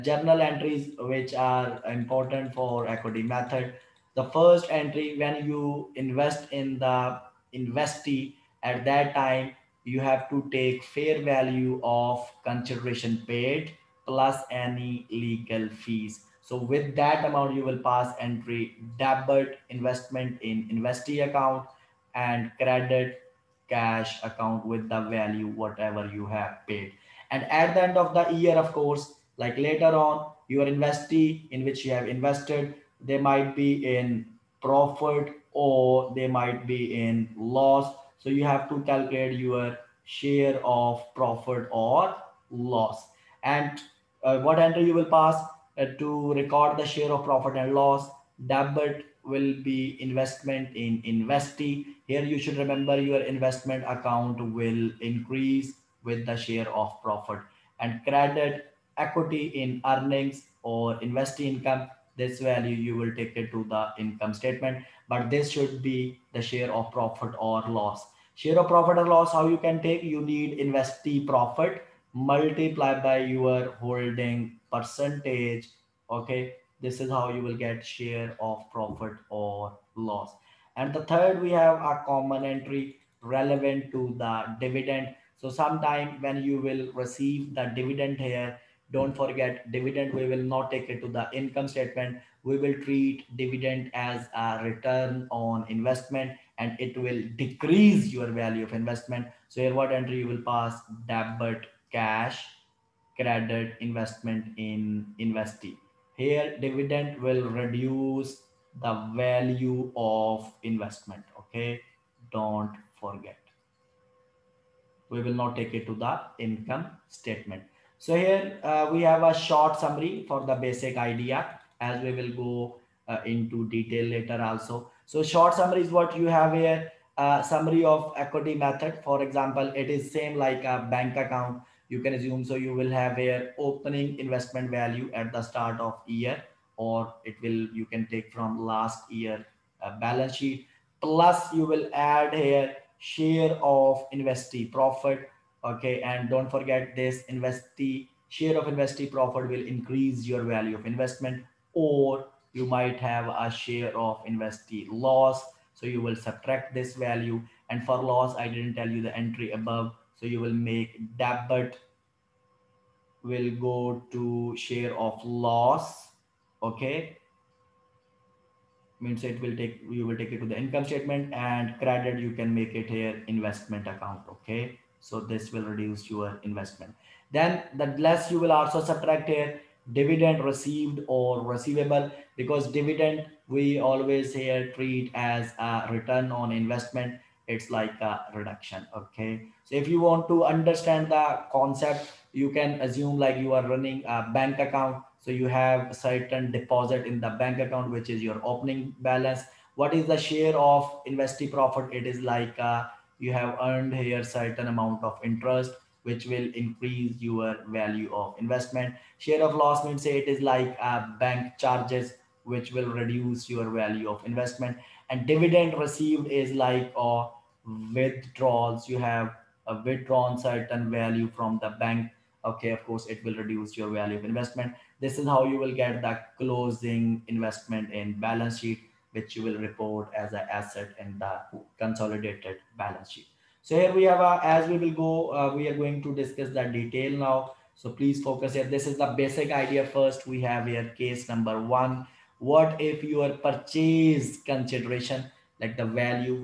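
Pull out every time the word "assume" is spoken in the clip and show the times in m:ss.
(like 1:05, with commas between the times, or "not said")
2:12, 3:12.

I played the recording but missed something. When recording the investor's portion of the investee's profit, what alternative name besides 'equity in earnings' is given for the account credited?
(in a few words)
investee income.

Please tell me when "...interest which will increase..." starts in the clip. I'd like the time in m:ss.
3:25.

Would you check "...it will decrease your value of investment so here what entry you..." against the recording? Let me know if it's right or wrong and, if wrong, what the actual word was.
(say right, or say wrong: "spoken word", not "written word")
right.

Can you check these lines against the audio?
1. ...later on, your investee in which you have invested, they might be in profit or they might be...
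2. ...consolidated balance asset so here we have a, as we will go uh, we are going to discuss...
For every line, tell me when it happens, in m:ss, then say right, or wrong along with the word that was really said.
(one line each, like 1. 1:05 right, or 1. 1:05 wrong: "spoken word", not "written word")
1. 0:29 right
2. 3:51 wrong: "sheet", not "asset".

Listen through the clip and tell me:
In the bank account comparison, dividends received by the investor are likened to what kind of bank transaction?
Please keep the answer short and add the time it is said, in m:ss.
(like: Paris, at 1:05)
withdrawals, at 3:37.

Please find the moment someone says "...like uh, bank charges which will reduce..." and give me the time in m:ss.
3:30.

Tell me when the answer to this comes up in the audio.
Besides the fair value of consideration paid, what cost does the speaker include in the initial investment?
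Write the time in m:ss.
0:15.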